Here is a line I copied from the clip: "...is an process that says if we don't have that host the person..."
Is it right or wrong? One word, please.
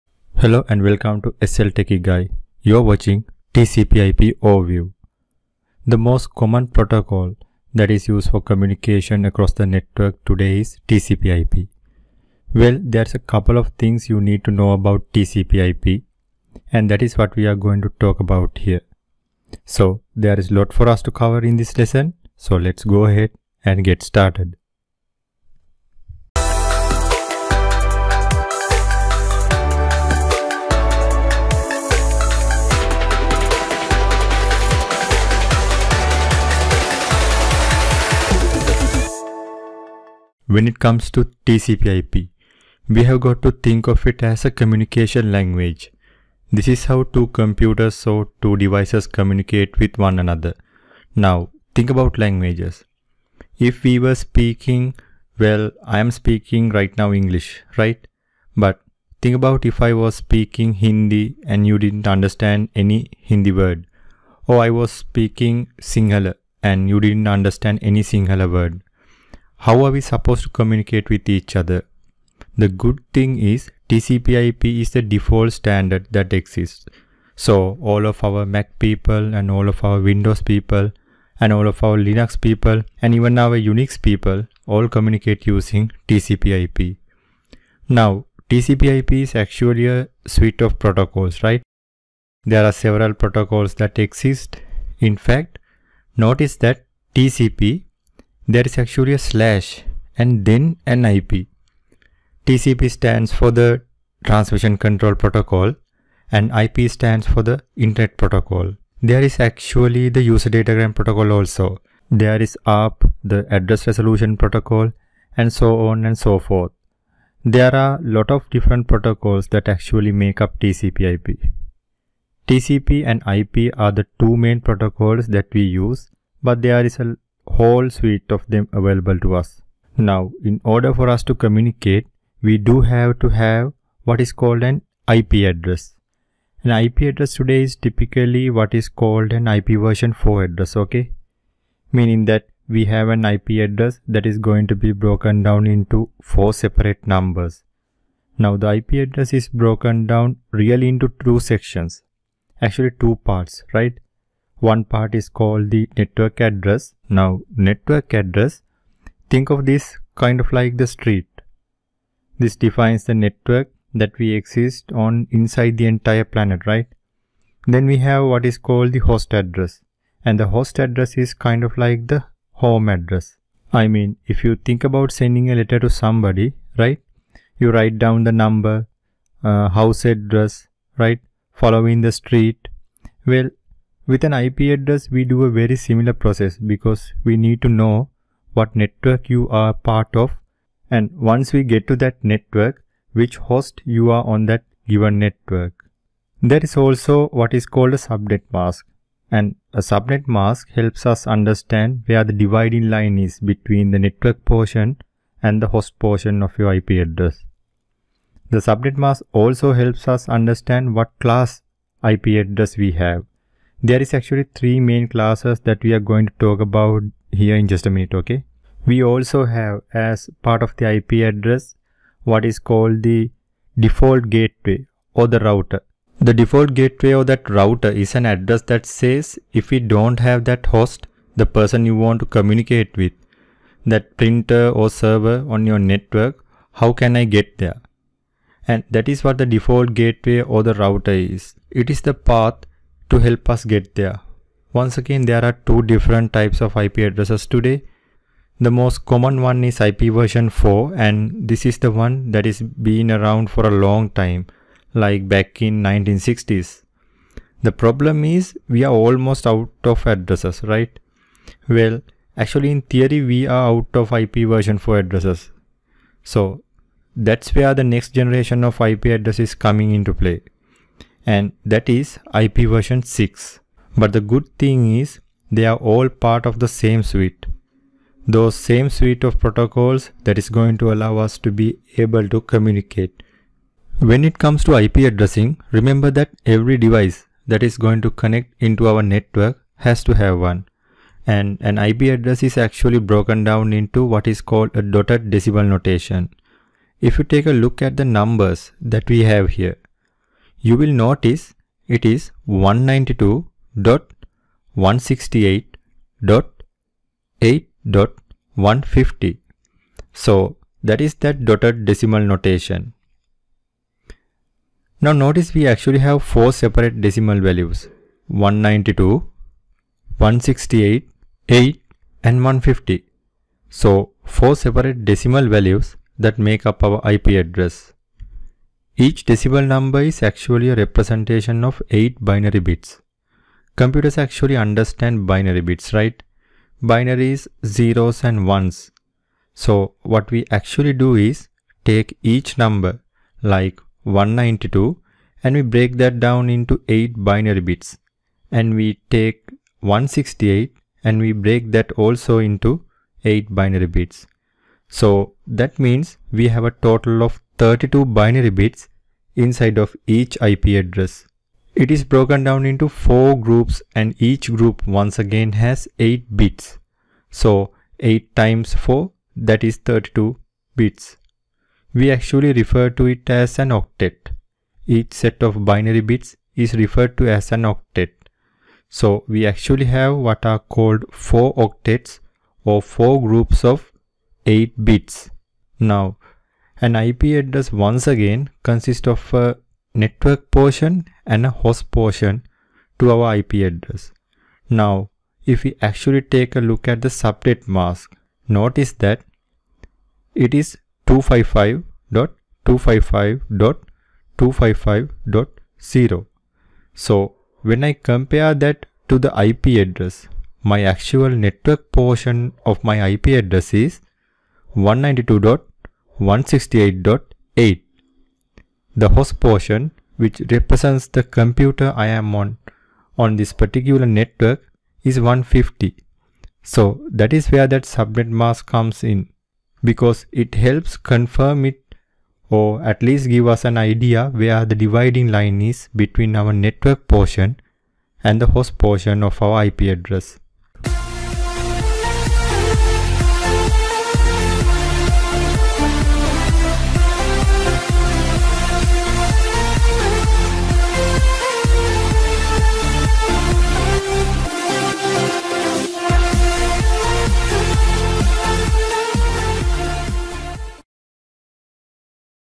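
wrong.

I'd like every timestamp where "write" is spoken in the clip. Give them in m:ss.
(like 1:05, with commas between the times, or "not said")
2:57.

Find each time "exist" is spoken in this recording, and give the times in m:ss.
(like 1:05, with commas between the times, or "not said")
1:16, 1:34, 2:44.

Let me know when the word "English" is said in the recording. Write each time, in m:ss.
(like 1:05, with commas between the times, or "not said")
0:57.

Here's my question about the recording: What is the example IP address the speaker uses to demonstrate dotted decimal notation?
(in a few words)
192.168.8.150.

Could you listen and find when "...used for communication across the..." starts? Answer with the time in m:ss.
0:08.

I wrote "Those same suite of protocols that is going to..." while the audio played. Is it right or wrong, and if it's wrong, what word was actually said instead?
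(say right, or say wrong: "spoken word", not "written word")
right.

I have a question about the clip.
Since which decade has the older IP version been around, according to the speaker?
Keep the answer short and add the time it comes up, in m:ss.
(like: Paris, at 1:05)
1960s, at 4:15.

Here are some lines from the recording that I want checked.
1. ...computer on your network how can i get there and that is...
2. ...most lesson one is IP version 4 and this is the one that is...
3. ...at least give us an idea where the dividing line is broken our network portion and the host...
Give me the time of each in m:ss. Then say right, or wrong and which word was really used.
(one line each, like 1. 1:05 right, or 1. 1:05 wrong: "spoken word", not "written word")
1. 3:54 wrong: "server", not "computer"
2. 4:08 wrong: "common", not "lesson"
3. 7:12 wrong: "between", not "broken".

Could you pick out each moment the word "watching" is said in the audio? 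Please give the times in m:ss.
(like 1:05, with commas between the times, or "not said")
0:02.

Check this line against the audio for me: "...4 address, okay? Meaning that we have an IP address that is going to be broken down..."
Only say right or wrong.
right.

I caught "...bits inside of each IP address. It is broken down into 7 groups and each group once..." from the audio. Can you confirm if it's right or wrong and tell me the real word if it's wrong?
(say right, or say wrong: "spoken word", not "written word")
wrong: "4", not "7".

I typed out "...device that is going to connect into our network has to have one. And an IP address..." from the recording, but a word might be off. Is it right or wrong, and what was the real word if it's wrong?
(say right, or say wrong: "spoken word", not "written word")
right.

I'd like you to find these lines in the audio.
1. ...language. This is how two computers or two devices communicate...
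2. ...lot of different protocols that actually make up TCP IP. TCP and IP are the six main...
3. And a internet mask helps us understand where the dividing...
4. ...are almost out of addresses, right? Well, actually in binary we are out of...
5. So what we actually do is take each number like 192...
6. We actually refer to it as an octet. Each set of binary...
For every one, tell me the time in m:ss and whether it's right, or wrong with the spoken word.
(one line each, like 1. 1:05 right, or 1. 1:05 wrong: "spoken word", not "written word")
1. 0:45 right
2. 1:58 wrong: "two", not "six"
3. 3:19 wrong: "subnet", not "internet"
4. 4:18 wrong: "theory", not "binary"
5. 5:39 right
6. 6:11 right.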